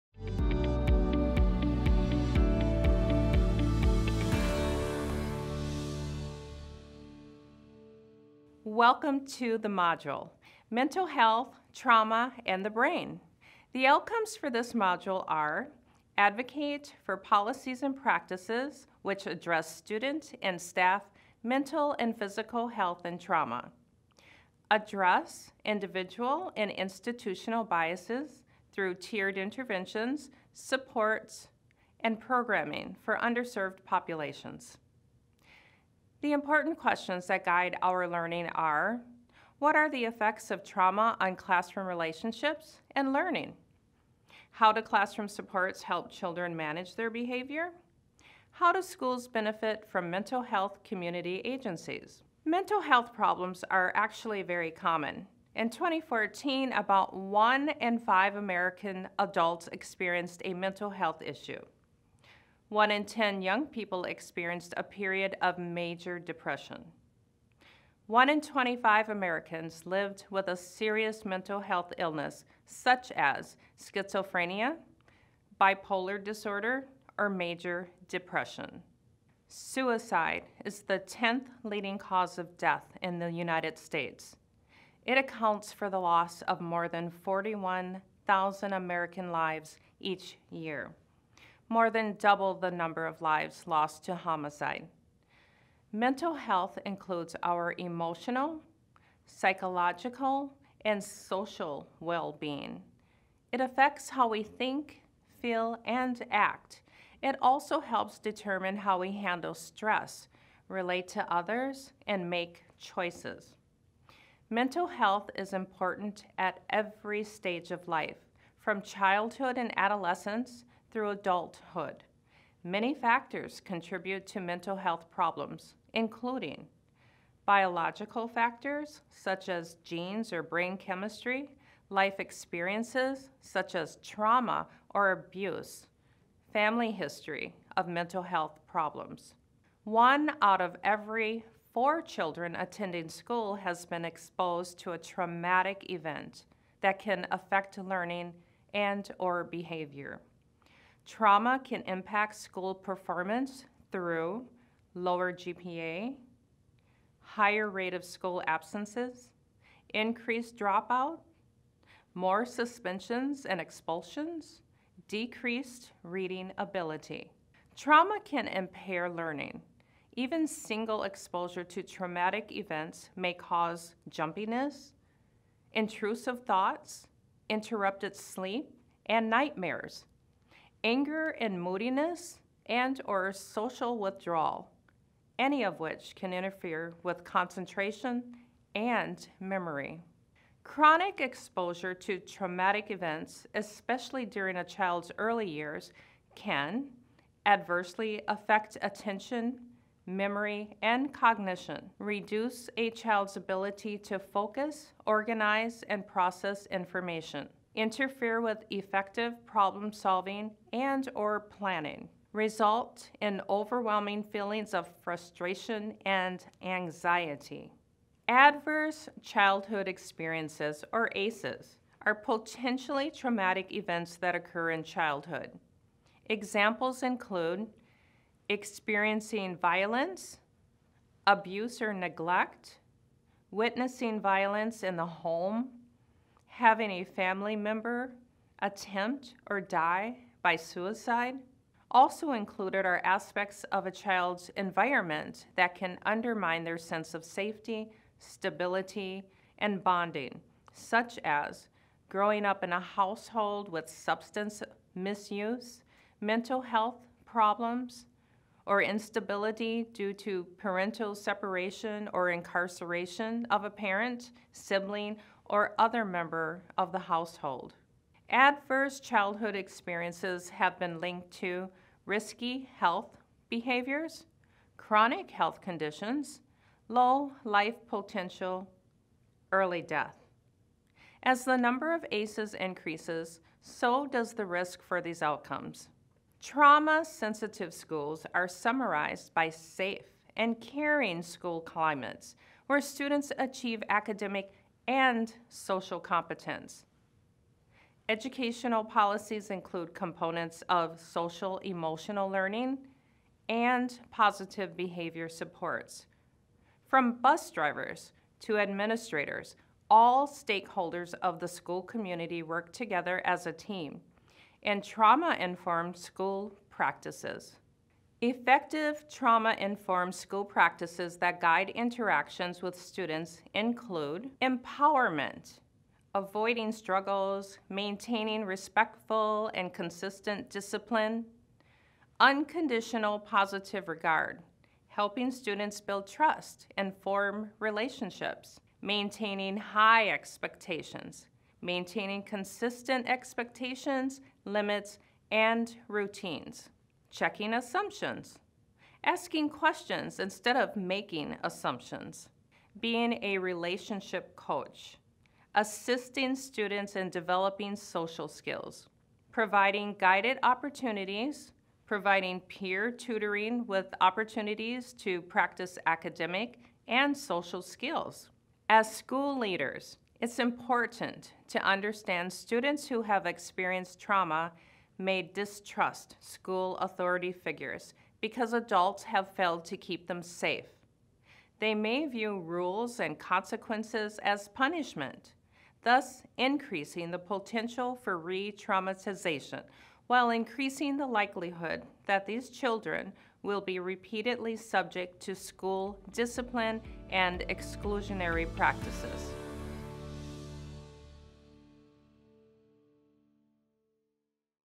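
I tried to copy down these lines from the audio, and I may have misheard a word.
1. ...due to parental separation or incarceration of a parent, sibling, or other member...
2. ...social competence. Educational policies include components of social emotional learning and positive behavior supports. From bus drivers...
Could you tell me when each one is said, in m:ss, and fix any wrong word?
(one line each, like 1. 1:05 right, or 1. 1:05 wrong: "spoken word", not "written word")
1. 4:19 right
2. 4:55 right.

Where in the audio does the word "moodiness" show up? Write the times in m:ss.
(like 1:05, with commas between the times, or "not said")
3:01.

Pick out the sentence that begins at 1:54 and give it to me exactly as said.
Mental health is important at every stage of life, from childhood and adolescence through adulthood.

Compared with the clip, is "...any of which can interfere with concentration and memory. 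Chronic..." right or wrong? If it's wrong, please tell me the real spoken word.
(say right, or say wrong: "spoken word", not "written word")
right.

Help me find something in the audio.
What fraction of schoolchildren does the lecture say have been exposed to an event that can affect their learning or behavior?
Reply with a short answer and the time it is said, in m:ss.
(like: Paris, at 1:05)
1 out of 4, at 2:19.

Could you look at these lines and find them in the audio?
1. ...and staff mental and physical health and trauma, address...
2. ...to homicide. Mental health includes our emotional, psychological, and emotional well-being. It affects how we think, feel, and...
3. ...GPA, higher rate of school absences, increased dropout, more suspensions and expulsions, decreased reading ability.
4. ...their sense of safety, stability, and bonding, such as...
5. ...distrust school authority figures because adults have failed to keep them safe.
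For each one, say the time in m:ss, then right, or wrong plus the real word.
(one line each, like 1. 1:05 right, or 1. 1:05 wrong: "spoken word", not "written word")
1. 0:20 right
2. 1:34 wrong: "social", not "emotional"
3. 2:35 right
4. 4:06 right
5. 6:15 right.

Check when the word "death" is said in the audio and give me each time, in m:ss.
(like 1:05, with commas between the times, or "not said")
1:22, 4:39.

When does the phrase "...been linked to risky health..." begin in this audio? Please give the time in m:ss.
4:30.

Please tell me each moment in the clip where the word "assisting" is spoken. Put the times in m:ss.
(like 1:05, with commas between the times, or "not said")
5:55.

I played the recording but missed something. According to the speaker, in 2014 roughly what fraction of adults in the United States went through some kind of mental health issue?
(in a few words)
1 in 5.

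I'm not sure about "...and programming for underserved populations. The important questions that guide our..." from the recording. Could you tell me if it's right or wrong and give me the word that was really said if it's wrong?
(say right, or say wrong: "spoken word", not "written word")
right.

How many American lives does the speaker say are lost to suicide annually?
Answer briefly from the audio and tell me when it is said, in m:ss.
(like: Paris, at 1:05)
41,000, at 1:27.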